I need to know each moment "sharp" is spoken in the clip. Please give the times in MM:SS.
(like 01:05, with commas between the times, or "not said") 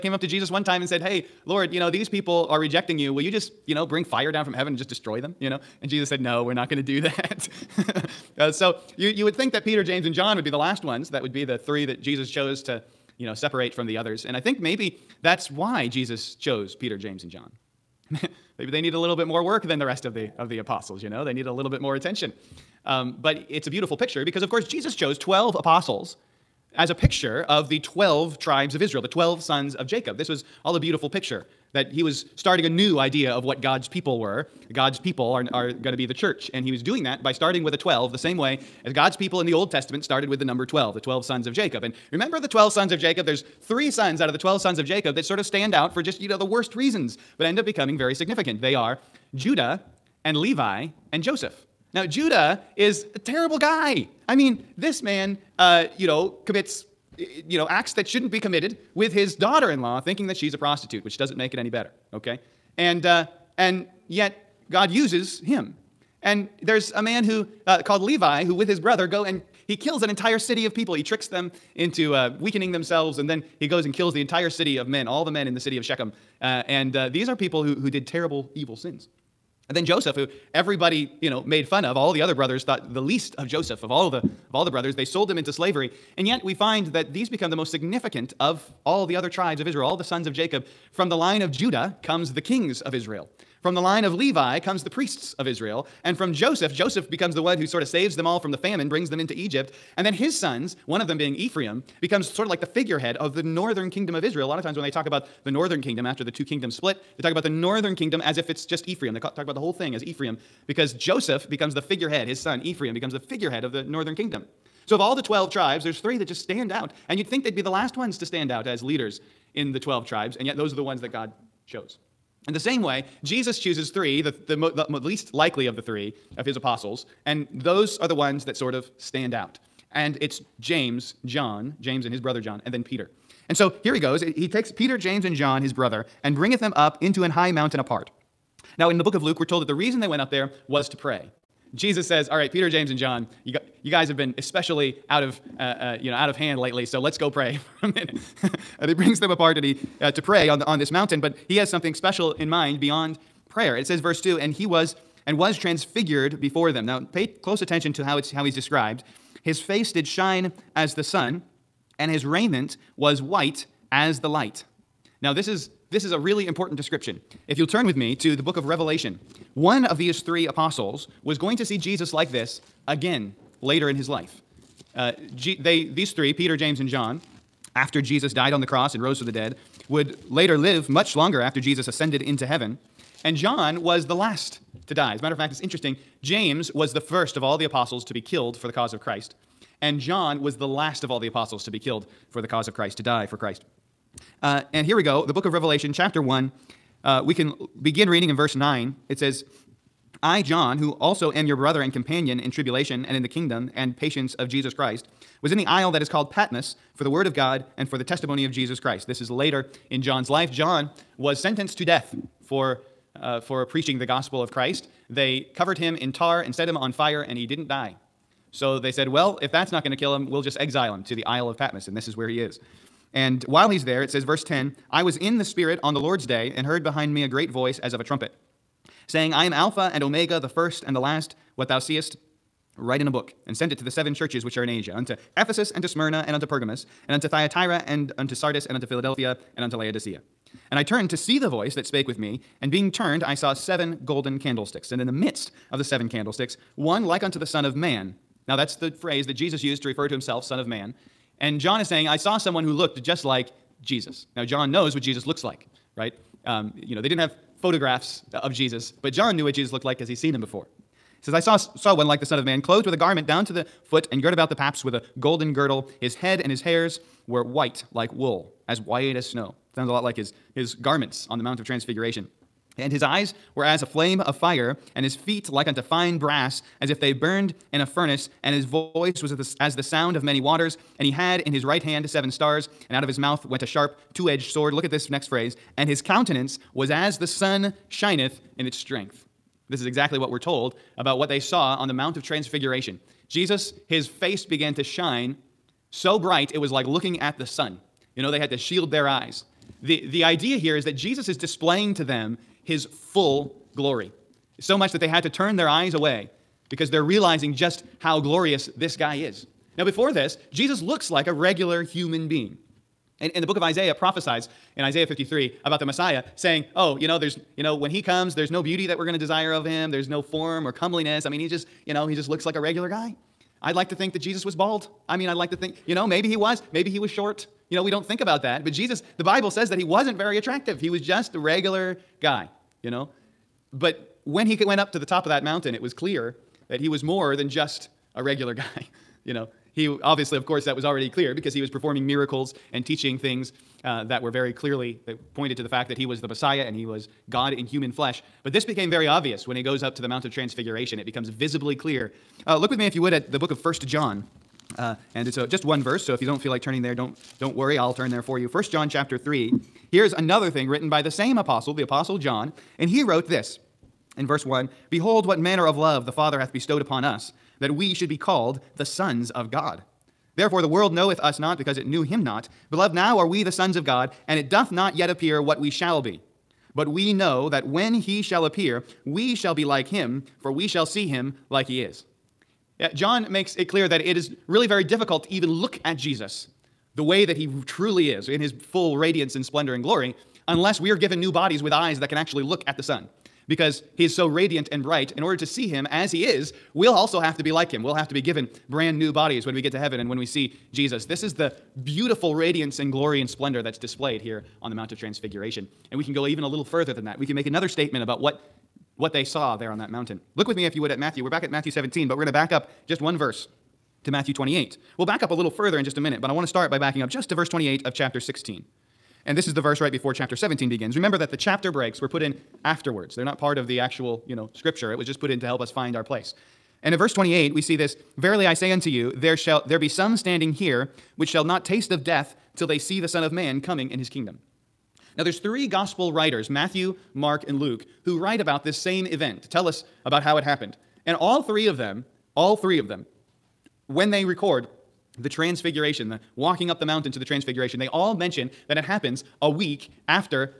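04:43.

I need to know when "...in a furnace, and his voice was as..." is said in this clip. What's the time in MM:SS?
04:37.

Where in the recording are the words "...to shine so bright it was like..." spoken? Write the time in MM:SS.
04:54.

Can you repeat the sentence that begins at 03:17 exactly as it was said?
Uh, we can begin reading in verse 9.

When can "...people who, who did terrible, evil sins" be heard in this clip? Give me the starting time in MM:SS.
01:17.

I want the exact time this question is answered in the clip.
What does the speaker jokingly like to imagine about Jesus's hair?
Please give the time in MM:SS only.
05:24.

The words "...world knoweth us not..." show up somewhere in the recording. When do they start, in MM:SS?
06:10.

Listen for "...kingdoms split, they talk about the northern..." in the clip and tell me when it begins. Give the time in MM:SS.
01:46.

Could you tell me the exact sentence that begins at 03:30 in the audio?
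John was sentenced to death for, uh, for preaching the gospel of Christ.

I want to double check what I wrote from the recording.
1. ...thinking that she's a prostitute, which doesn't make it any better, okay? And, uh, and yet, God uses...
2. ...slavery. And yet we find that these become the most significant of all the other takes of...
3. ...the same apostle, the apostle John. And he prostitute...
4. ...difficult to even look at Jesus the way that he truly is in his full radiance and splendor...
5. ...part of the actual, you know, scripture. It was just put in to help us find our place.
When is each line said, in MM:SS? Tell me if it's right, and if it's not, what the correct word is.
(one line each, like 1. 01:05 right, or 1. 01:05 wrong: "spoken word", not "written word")
1. 00:59 right
2. 01:25 wrong: "tribes", not "takes"
3. 06:00 wrong: "wrote", not "prostitute"
4. 06:24 right
5. 07:03 right.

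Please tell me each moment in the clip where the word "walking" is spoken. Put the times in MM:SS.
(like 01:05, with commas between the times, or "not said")
07:26.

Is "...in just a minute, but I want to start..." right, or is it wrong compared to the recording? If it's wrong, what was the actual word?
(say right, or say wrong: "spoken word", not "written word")
right.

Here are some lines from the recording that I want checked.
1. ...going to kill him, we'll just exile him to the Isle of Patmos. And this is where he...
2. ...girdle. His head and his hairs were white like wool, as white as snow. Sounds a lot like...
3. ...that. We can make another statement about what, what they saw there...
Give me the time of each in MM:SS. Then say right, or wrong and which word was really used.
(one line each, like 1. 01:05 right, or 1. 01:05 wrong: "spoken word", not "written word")
1. 03:39 right
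2. 04:25 right
3. 06:47 right.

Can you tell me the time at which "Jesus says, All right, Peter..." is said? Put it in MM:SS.
02:21.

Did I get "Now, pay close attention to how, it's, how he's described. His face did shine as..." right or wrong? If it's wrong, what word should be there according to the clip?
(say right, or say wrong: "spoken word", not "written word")
right.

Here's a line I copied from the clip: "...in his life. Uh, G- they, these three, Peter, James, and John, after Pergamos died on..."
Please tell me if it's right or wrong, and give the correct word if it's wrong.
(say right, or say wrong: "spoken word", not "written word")
wrong: "Jesus", not "Pergamos".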